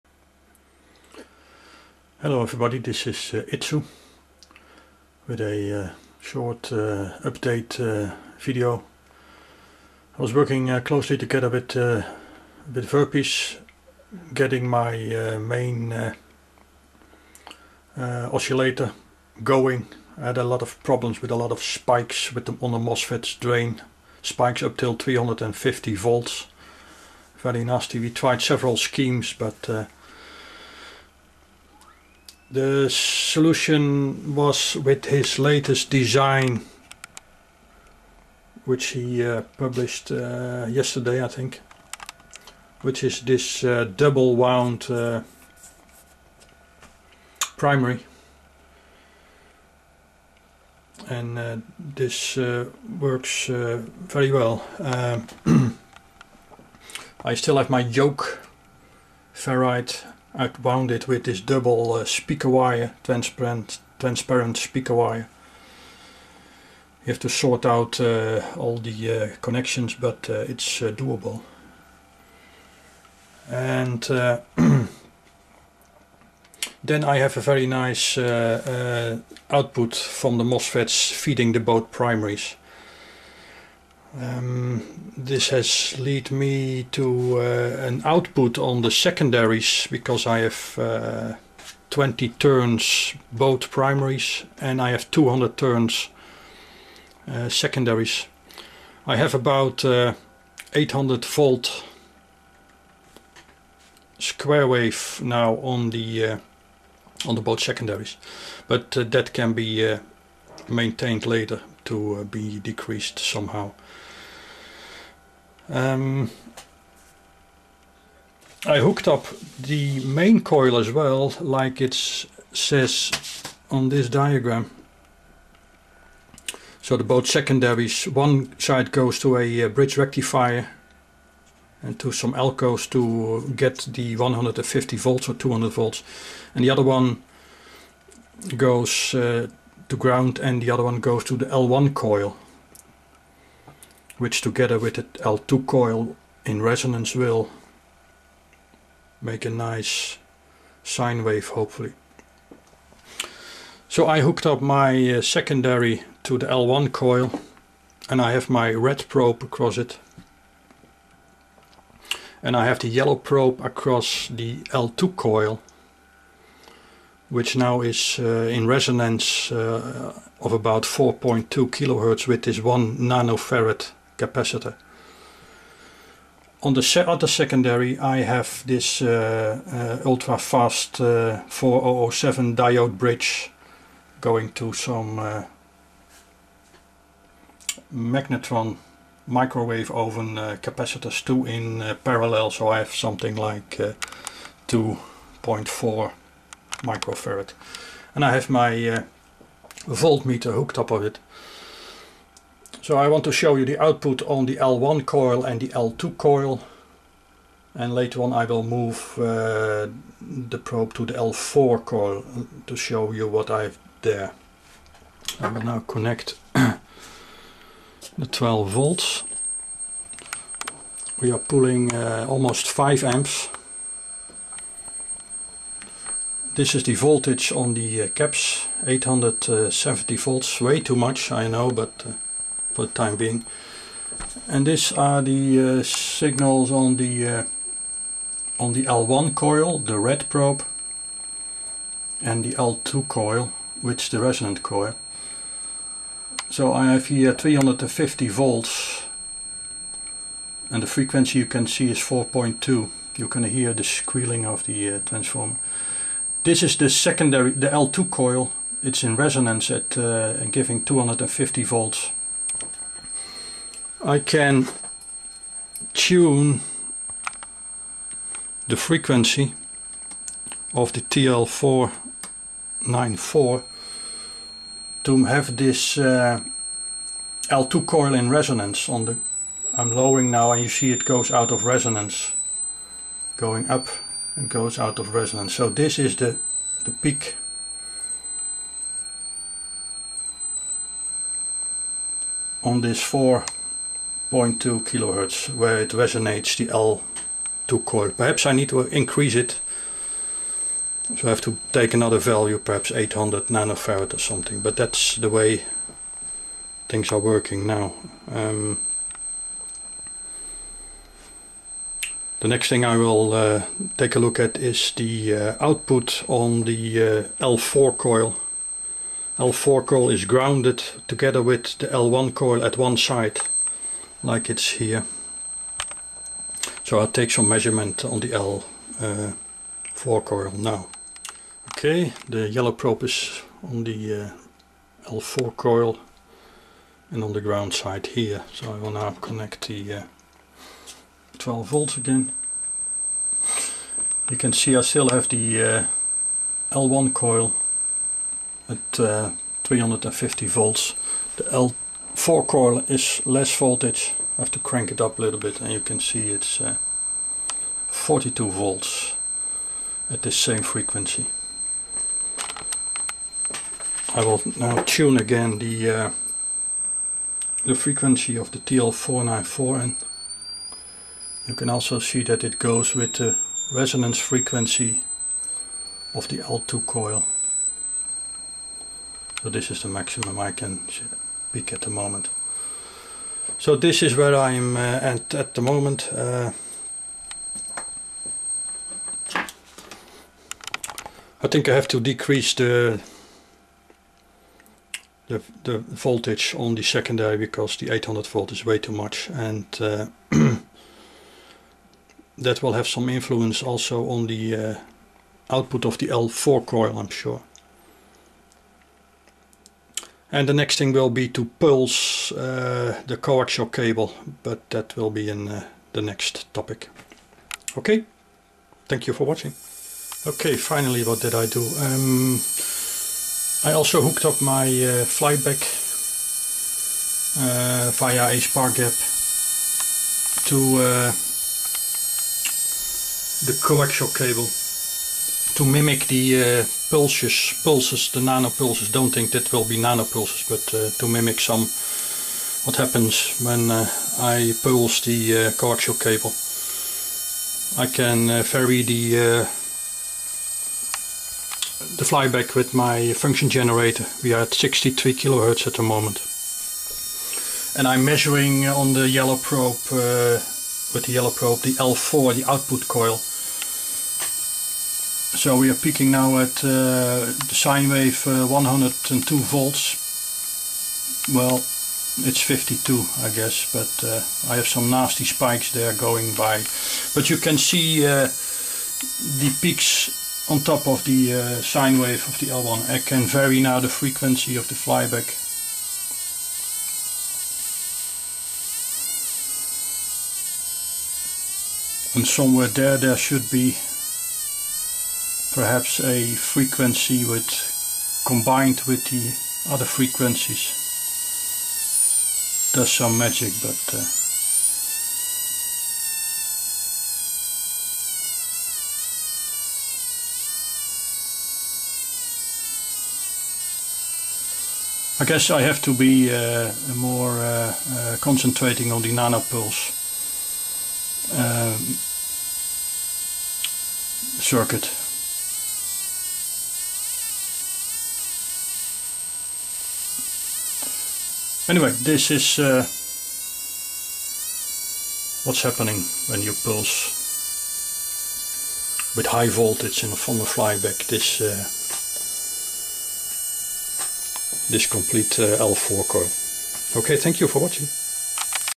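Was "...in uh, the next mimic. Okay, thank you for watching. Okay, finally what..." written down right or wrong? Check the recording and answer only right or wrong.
wrong.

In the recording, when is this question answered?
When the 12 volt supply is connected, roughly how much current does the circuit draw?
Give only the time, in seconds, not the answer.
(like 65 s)
222 s.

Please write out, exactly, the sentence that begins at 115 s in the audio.
Um, I hooked up the main coil as well, like it says on this diagram.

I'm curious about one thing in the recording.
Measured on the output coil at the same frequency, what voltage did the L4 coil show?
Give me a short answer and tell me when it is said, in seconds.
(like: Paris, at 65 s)
42 volts, at 357 s.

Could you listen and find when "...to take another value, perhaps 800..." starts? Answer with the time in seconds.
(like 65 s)
301 s.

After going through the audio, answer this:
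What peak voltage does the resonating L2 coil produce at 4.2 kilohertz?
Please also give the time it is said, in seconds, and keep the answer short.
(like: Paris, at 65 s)
250 volts, at 260 s.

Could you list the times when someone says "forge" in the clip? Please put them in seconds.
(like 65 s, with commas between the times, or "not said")
not said.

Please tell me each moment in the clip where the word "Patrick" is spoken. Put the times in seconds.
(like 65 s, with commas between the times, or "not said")
not said.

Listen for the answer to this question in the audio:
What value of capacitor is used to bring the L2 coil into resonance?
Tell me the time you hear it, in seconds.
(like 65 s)
172 s.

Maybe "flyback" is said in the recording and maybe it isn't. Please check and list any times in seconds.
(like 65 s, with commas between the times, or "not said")
425 s, 452 s, 484 s, 540 s.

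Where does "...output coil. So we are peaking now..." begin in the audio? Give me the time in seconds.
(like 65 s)
462 s.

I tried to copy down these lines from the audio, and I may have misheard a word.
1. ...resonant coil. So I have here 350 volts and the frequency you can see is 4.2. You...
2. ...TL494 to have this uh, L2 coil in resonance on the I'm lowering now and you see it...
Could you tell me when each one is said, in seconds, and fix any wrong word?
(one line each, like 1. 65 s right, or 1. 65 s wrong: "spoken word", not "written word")
1. 244 s right
2. 271 s right.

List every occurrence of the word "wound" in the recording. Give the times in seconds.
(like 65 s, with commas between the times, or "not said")
44 s, 60 s.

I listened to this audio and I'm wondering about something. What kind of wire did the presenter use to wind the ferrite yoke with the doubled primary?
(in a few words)
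transparent speaker wire.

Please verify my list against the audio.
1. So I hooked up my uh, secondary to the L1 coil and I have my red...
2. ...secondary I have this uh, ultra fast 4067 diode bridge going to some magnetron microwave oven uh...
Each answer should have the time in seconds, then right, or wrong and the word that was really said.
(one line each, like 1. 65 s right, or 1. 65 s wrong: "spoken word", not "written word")
1. 153 s right
2. 177 s wrong: "4007", not "4067".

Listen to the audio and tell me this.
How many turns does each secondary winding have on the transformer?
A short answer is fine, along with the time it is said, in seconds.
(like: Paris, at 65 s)
200, at 95 s.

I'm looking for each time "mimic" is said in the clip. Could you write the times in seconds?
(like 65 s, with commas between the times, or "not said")
435 s, 441 s.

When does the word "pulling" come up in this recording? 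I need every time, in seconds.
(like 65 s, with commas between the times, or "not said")
221 s.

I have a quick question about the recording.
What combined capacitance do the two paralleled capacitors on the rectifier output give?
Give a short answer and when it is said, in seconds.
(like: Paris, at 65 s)
2.4 microfarad, at 194 s.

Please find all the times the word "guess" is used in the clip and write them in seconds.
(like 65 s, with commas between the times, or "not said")
473 s, 515 s.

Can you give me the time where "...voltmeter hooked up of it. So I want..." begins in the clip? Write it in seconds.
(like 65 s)
199 s.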